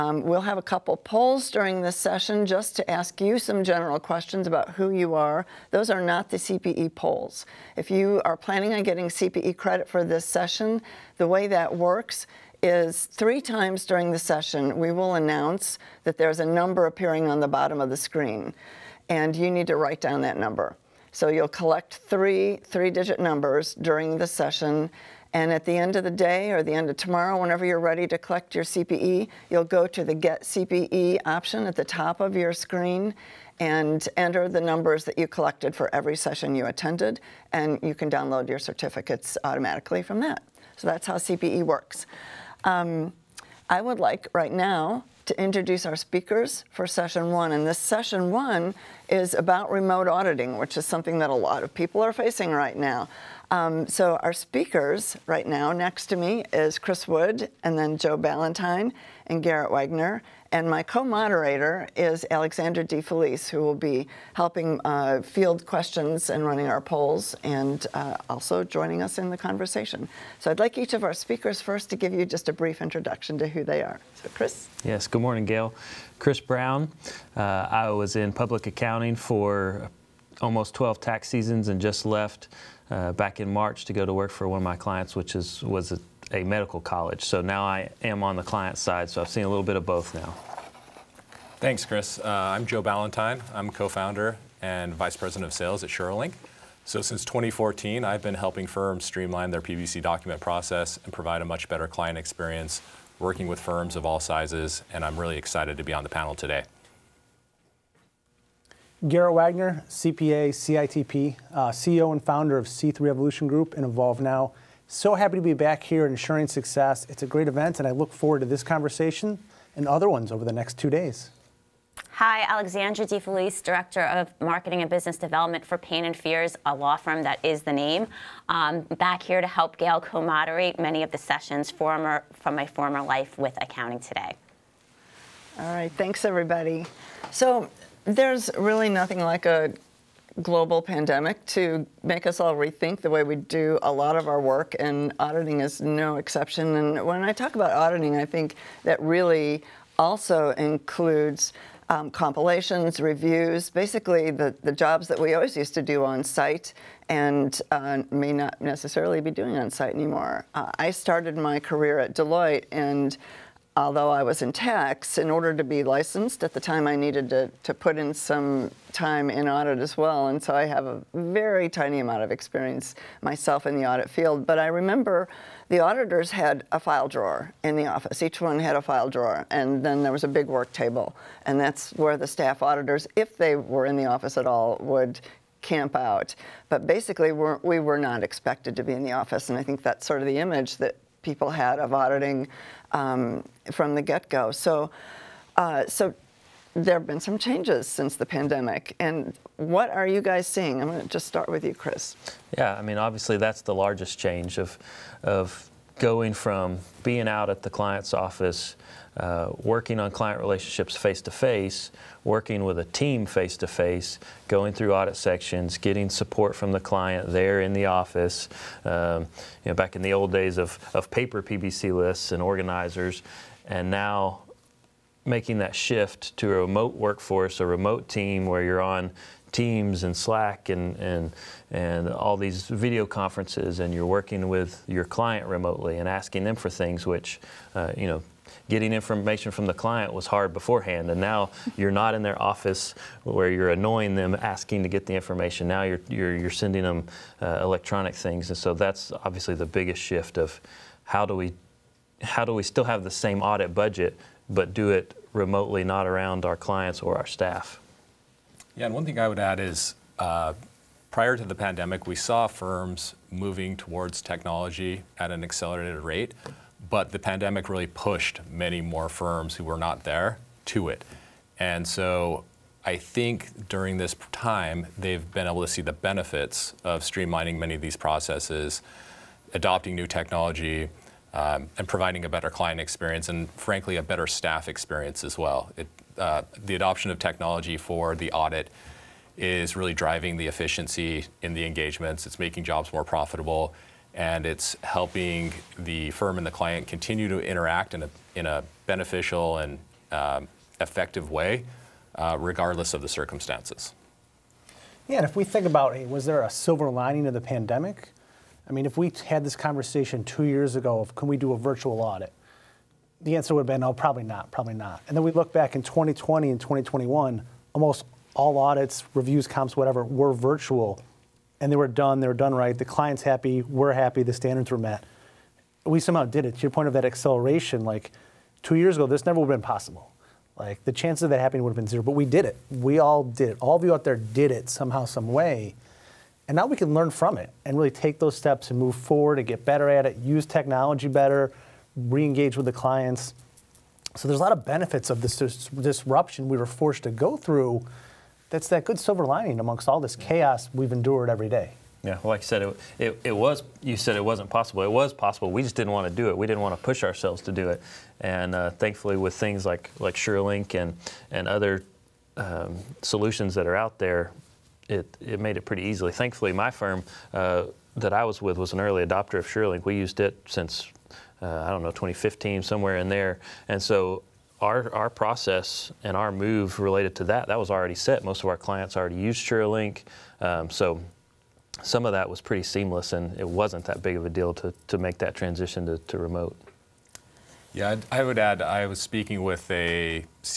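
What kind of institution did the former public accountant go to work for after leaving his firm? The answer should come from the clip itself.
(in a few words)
a medical college.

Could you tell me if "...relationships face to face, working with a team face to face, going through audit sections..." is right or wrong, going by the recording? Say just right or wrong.
right.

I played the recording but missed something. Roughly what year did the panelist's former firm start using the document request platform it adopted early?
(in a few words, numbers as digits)
2015.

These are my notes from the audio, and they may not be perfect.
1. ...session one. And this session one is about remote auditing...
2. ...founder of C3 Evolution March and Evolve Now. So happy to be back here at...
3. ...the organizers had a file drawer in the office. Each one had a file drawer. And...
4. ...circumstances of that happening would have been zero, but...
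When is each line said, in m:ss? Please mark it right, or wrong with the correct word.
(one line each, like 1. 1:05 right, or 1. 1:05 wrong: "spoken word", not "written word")
1. 0:46 right
2. 1:52 wrong: "Group", not "March"
3. 2:55 wrong: "auditors", not "organizers"
4. 5:30 wrong: "chances", not "circumstances".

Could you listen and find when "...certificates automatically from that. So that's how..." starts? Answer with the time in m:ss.
0:38.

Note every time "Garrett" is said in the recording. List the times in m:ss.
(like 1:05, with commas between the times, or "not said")
0:59, 1:49.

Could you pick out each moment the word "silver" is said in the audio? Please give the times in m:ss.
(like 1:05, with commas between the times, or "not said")
5:06, 5:48.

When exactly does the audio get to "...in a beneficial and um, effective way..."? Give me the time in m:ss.
4:58.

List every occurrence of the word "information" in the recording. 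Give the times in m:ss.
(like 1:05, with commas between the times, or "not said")
3:58, 4:05.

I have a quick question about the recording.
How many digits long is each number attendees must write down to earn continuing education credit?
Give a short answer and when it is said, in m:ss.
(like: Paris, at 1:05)
3, at 0:22.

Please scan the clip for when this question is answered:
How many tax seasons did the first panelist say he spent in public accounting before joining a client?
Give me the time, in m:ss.
1:20.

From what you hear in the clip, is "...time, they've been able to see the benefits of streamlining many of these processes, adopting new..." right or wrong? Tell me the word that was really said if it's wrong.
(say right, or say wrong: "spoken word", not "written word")
right.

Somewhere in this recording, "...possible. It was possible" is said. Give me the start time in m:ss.
5:54.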